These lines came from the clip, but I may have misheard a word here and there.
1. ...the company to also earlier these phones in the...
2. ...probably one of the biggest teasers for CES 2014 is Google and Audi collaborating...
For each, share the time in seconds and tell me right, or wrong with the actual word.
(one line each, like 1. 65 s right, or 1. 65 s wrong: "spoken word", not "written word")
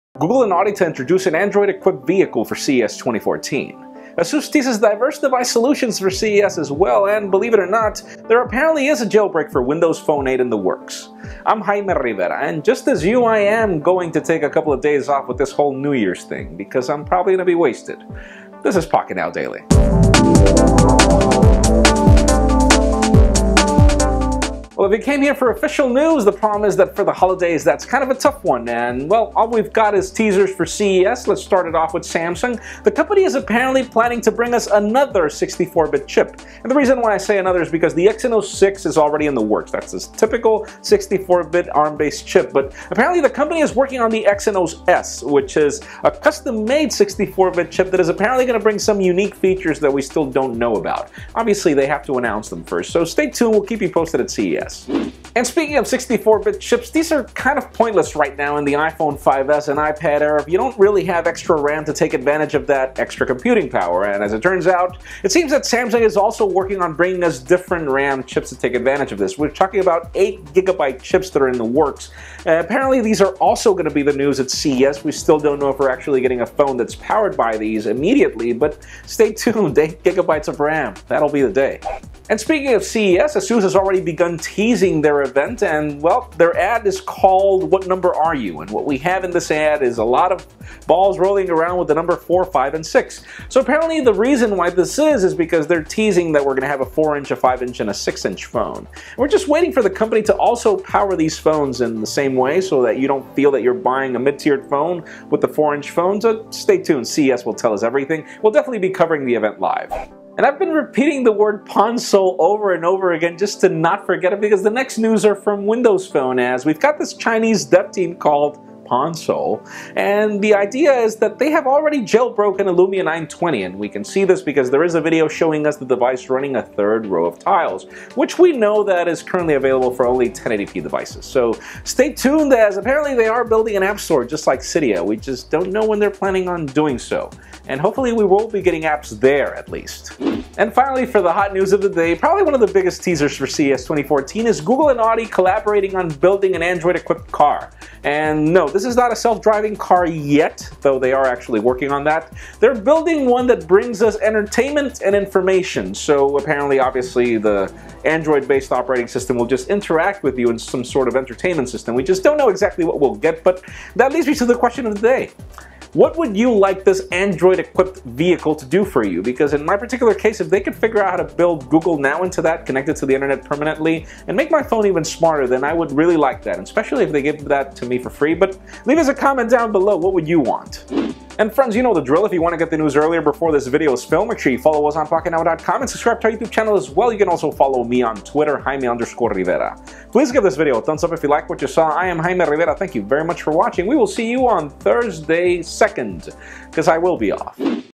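1. 99 s wrong: "power", not "earlier"
2. 142 s right.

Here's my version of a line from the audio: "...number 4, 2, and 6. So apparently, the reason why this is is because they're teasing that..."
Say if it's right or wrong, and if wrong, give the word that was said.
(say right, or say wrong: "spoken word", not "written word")
wrong: "5", not "2".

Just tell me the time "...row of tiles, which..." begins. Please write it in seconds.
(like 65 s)
127 s.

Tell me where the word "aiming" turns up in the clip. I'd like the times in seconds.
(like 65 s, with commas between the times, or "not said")
not said.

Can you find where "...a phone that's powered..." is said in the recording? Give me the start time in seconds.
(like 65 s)
76 s.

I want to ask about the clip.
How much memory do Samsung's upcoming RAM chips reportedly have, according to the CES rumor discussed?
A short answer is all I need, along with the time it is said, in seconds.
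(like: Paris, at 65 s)
8 GB, at 70 s.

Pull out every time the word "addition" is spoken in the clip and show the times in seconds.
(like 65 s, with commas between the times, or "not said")
not said.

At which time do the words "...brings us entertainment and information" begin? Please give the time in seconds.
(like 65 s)
153 s.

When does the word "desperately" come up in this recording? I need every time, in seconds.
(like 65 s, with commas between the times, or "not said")
not said.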